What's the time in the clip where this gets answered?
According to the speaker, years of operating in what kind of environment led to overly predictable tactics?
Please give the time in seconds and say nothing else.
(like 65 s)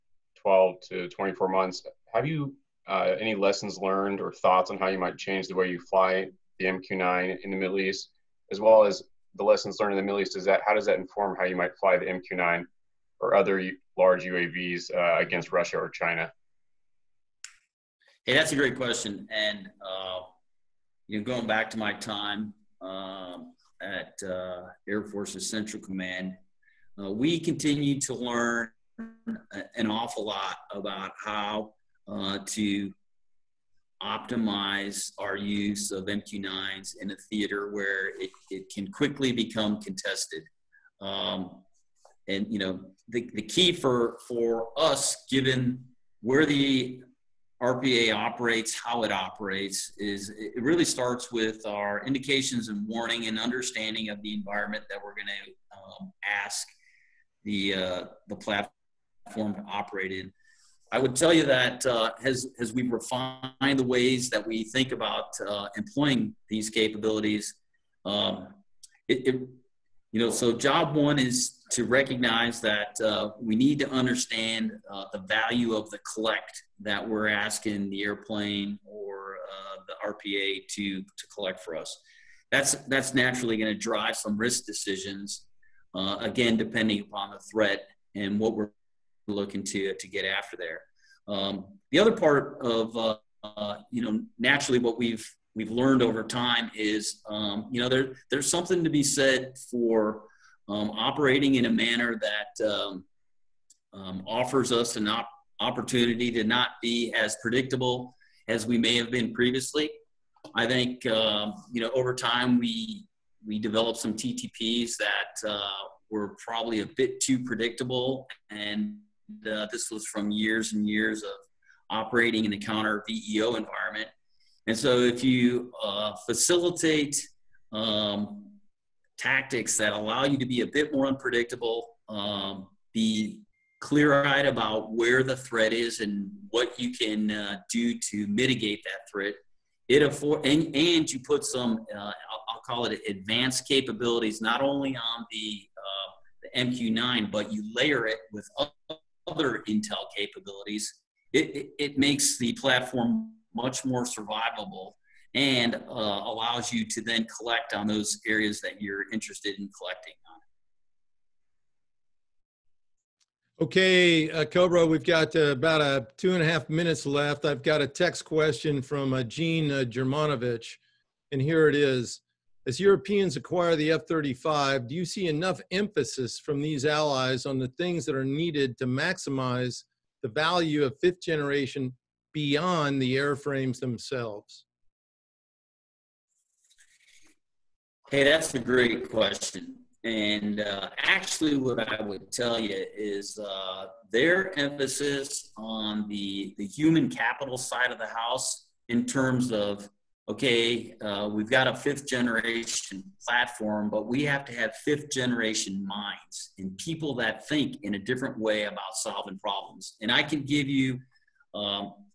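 122 s.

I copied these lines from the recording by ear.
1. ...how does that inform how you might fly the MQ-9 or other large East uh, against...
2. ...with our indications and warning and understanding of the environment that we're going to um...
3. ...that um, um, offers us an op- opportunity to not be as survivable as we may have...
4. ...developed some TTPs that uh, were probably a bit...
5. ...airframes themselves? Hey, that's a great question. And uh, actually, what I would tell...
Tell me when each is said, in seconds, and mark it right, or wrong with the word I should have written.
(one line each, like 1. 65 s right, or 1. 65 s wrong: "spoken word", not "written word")
1. 10 s wrong: "UAVs", not "East"
2. 51 s right
3. 102 s wrong: "predictable", not "survivable"
4. 113 s right
5. 183 s right.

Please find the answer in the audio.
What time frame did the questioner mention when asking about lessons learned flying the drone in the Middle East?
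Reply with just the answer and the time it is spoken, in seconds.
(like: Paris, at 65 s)
12 to 24 months, at 0 s.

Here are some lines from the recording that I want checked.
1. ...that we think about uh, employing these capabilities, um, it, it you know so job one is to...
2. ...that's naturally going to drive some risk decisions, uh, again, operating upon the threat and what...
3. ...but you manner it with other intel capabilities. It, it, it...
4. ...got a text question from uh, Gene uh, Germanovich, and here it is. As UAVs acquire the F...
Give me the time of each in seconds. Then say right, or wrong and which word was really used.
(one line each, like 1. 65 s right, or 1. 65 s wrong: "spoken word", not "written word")
1. 64 s right
2. 82 s wrong: "depending", not "operating"
3. 147 s wrong: "layer", not "manner"
4. 167 s wrong: "Europeans", not "UAVs".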